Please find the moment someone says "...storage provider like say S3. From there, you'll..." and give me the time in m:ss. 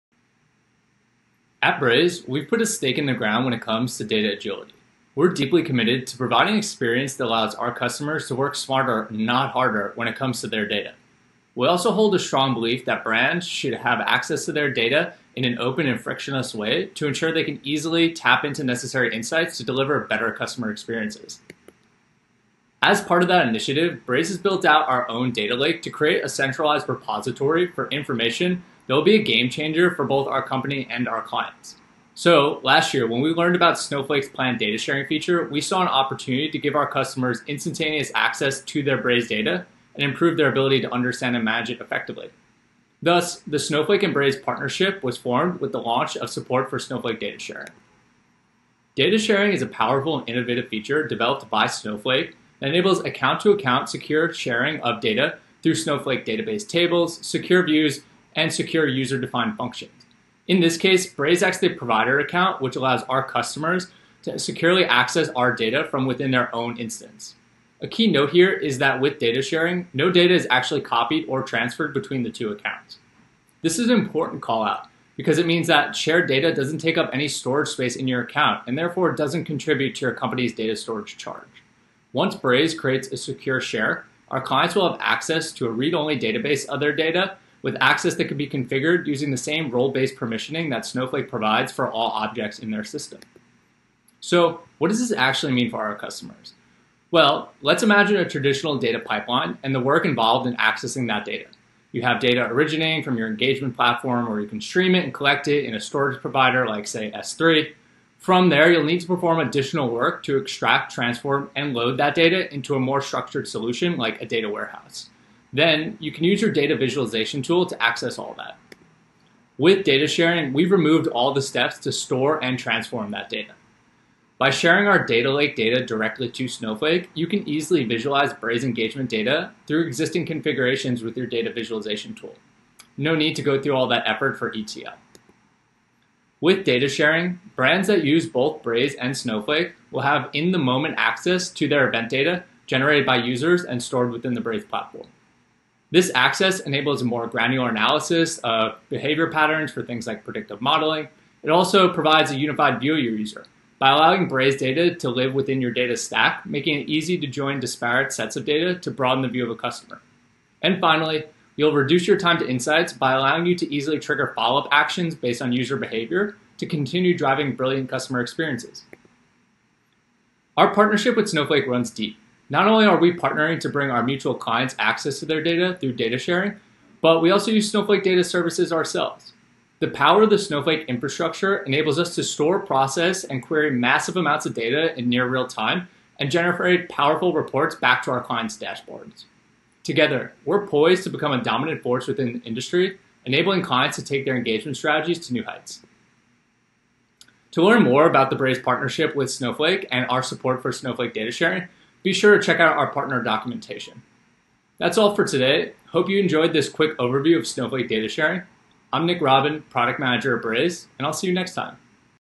1:45.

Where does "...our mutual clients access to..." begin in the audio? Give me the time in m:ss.
2:53.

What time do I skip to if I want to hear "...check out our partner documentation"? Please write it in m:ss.
3:22.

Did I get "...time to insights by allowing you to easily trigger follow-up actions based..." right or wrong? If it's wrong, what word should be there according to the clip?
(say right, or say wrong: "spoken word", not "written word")
right.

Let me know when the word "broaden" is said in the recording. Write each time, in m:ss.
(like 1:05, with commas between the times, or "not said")
2:38.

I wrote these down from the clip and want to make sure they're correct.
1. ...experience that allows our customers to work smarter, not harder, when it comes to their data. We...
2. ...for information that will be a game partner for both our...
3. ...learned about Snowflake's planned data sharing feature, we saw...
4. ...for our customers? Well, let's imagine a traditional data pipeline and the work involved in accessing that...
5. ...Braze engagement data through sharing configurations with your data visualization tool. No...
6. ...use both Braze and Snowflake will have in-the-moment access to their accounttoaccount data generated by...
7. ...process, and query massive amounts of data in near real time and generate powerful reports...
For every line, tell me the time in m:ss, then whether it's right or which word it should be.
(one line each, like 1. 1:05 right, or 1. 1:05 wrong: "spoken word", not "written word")
1. 0:06 right
2. 0:27 wrong: "changer", not "partner"
3. 0:33 right
4. 1:35 right
5. 2:08 wrong: "existing", not "sharing"
6. 2:18 wrong: "event", not "accounttoaccount"
7. 3:02 right.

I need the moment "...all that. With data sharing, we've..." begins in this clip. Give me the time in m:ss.
1:58.